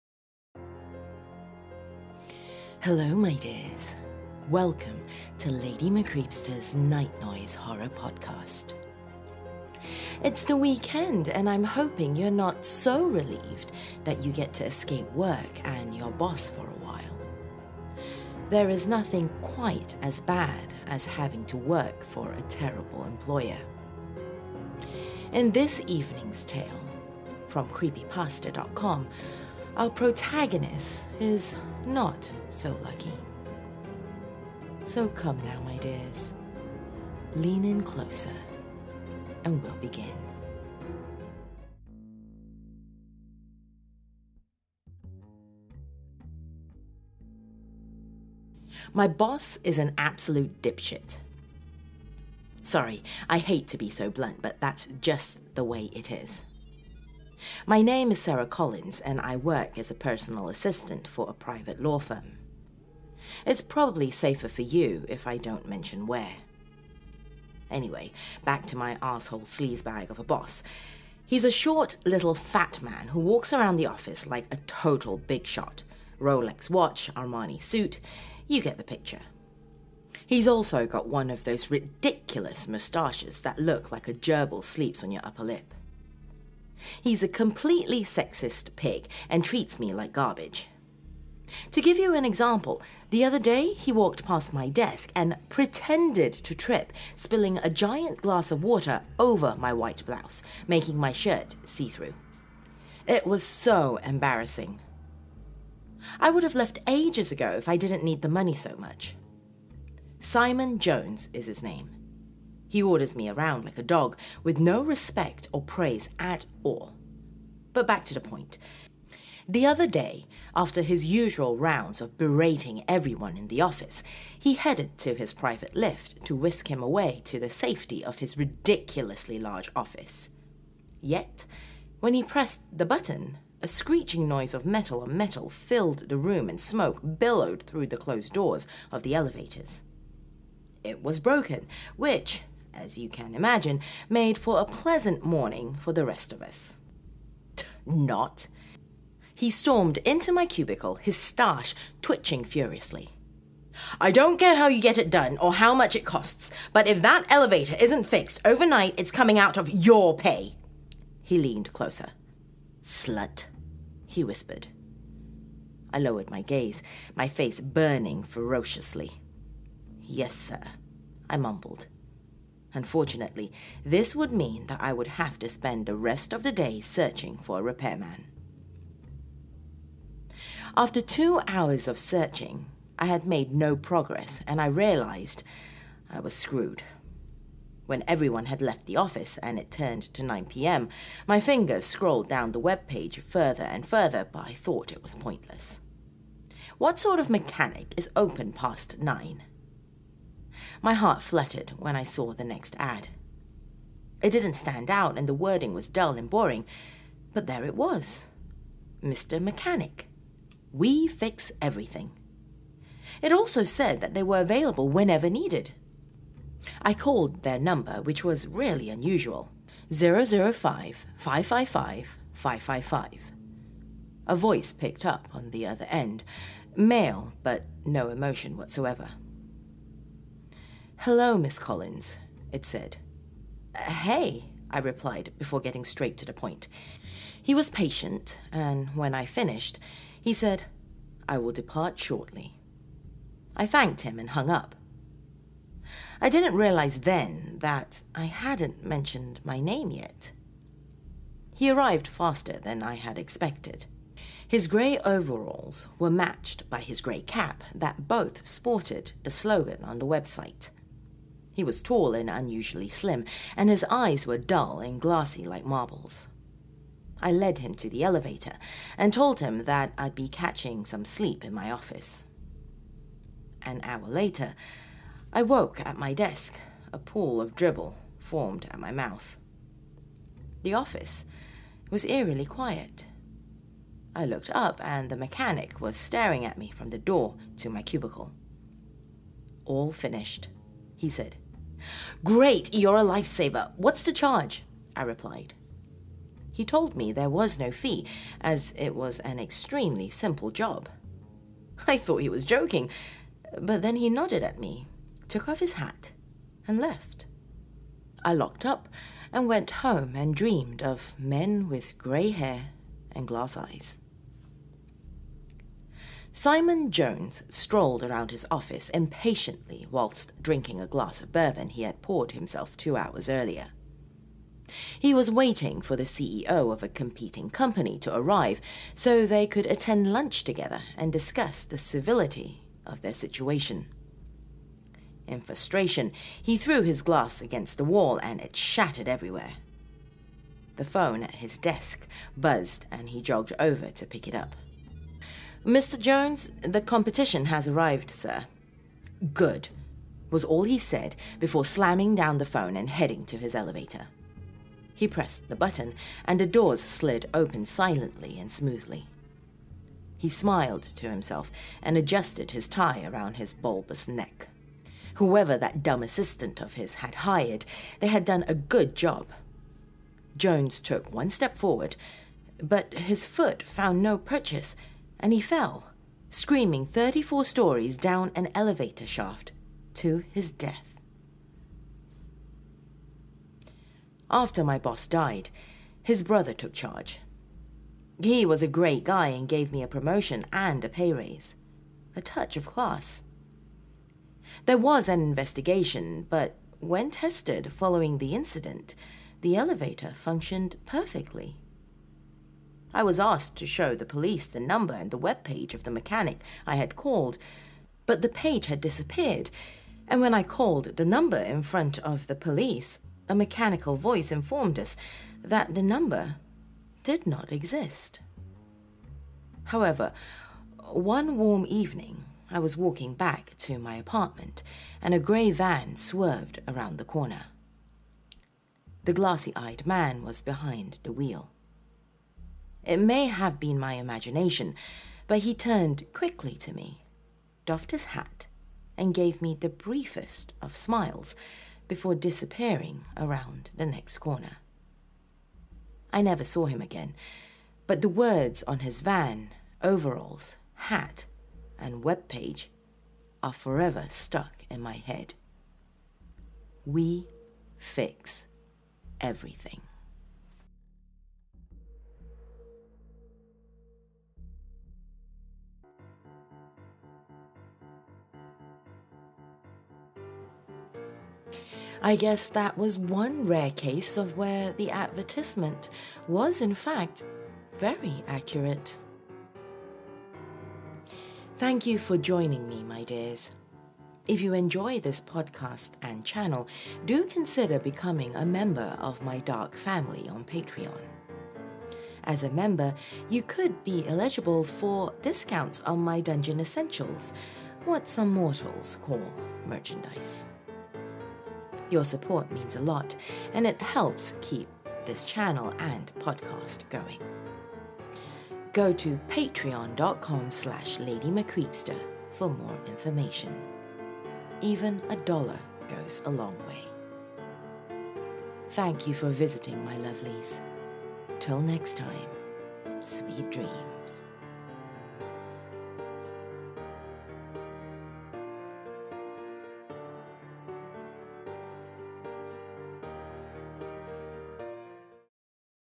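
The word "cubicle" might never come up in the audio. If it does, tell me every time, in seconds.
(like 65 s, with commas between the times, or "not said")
150 s, 287 s.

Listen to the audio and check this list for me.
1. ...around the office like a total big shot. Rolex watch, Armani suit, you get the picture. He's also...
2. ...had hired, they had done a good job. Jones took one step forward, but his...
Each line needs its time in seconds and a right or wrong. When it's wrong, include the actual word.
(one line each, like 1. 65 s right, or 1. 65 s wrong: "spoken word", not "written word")
1. 73 s right
2. 366 s right.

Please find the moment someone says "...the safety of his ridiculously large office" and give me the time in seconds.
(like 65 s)
127 s.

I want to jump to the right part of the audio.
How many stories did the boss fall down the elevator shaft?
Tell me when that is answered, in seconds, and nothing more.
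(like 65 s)
376 s.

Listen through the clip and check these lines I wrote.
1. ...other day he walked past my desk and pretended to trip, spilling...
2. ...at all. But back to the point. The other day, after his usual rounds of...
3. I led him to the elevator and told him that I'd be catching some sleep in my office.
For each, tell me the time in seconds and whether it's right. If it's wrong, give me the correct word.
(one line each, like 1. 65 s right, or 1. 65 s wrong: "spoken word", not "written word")
1. 93 s right
2. 116 s right
3. 267 s right.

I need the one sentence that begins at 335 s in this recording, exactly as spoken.
In frustration, he threw his glass against the wall and it shattered everywhere.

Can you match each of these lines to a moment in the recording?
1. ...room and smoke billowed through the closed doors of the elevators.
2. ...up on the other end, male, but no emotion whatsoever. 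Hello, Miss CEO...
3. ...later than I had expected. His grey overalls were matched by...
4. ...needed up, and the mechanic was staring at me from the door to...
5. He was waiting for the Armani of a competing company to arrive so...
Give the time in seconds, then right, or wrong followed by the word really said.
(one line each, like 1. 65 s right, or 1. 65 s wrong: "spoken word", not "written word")
1. 136 s right
2. 225 s wrong: "Collins", not "CEO"
3. 252 s wrong: "faster", not "later"
4. 284 s wrong: "looked", not "needed"
5. 324 s wrong: "CEO", not "Armani".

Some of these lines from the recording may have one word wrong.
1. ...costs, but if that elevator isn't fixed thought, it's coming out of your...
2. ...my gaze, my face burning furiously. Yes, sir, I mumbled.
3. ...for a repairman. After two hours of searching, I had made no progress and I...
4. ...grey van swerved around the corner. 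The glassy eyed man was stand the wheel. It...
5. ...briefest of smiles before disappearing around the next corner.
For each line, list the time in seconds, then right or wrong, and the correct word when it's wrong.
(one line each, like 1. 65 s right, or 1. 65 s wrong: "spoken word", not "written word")
1. 156 s wrong: "overnight", not "thought"
2. 166 s wrong: "ferociously", not "furiously"
3. 177 s right
4. 425 s wrong: "behind", not "stand"
5. 439 s right.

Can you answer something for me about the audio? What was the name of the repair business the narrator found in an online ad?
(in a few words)
Mr. Mechanic.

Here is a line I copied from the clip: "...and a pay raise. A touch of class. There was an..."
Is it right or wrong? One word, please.
right.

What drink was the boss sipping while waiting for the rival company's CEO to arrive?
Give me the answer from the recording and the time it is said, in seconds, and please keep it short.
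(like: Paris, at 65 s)
Bourbon, at 321 s.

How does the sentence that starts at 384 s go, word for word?
After my boss died, his brother took charge.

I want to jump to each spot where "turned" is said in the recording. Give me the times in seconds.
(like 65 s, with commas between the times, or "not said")
189 s, 435 s.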